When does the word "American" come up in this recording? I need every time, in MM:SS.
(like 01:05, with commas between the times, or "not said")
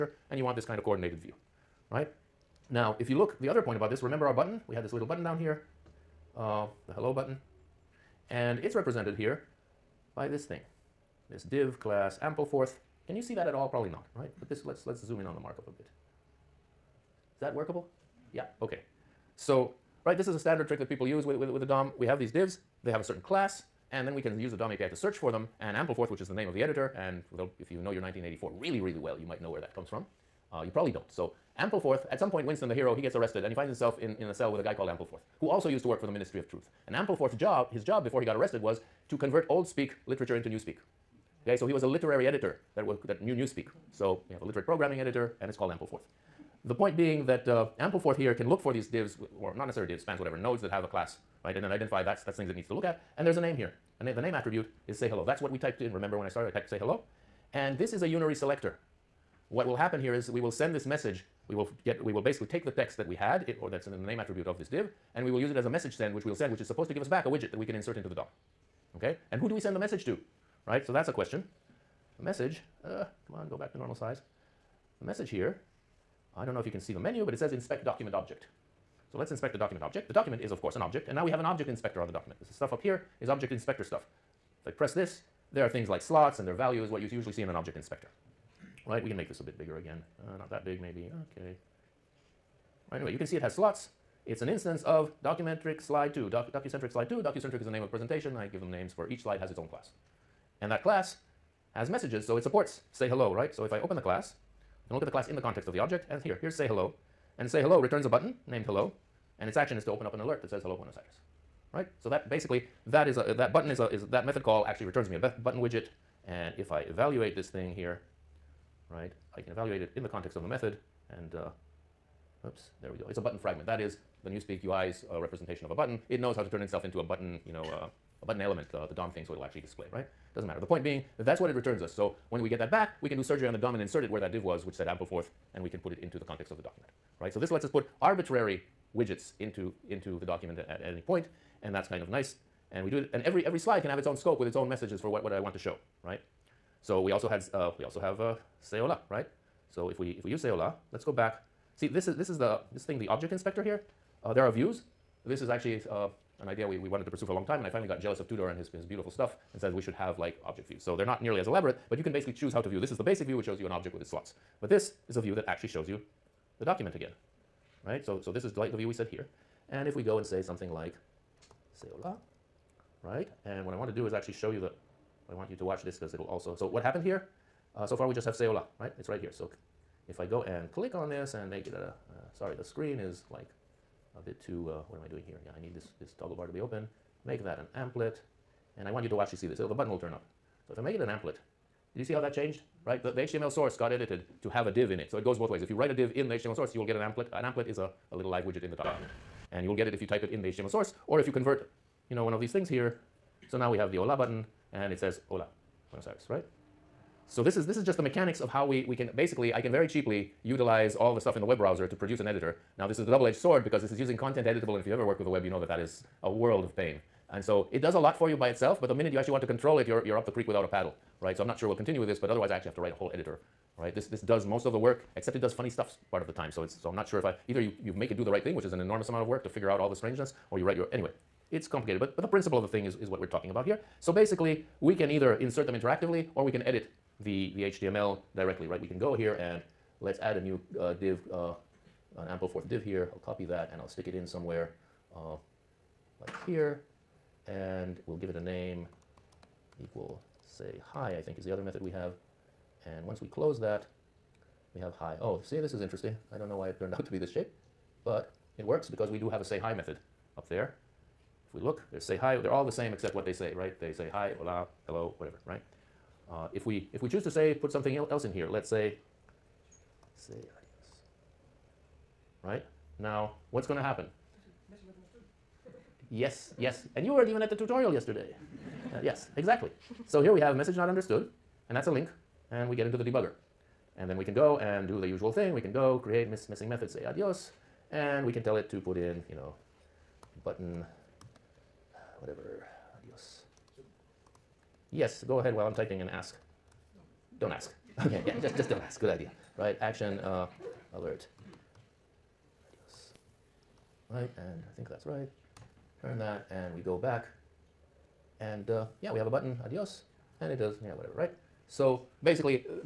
not said.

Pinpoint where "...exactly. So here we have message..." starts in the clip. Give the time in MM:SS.
04:39.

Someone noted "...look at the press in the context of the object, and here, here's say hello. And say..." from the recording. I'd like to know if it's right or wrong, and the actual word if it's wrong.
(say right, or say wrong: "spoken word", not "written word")
wrong: "class", not "press".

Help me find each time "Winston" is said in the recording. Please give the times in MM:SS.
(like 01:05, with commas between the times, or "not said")
00:32.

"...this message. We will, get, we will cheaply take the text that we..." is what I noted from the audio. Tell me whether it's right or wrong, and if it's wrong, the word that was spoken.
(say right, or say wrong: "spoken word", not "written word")
wrong: "basically", not "cheaply".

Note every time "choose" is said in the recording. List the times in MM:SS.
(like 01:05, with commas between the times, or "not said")
02:42, 04:27.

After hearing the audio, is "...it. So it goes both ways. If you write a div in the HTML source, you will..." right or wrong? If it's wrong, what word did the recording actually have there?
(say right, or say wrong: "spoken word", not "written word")
right.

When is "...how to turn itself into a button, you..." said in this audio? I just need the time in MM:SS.
02:06.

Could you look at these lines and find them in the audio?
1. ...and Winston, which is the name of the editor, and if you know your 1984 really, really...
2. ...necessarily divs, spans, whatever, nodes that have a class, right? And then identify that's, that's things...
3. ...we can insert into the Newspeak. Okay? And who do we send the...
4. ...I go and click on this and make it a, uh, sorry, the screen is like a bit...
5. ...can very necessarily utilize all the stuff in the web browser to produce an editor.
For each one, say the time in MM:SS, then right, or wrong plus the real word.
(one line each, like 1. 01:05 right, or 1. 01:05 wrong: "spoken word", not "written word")
1. 00:25 wrong: "Ampleforth", not "Winston"
2. 00:49 right
3. 01:07 wrong: "DOM", not "Newspeak"
4. 03:00 right
5. 03:29 wrong: "cheaply", not "necessarily".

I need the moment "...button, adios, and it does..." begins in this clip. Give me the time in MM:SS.
05:09.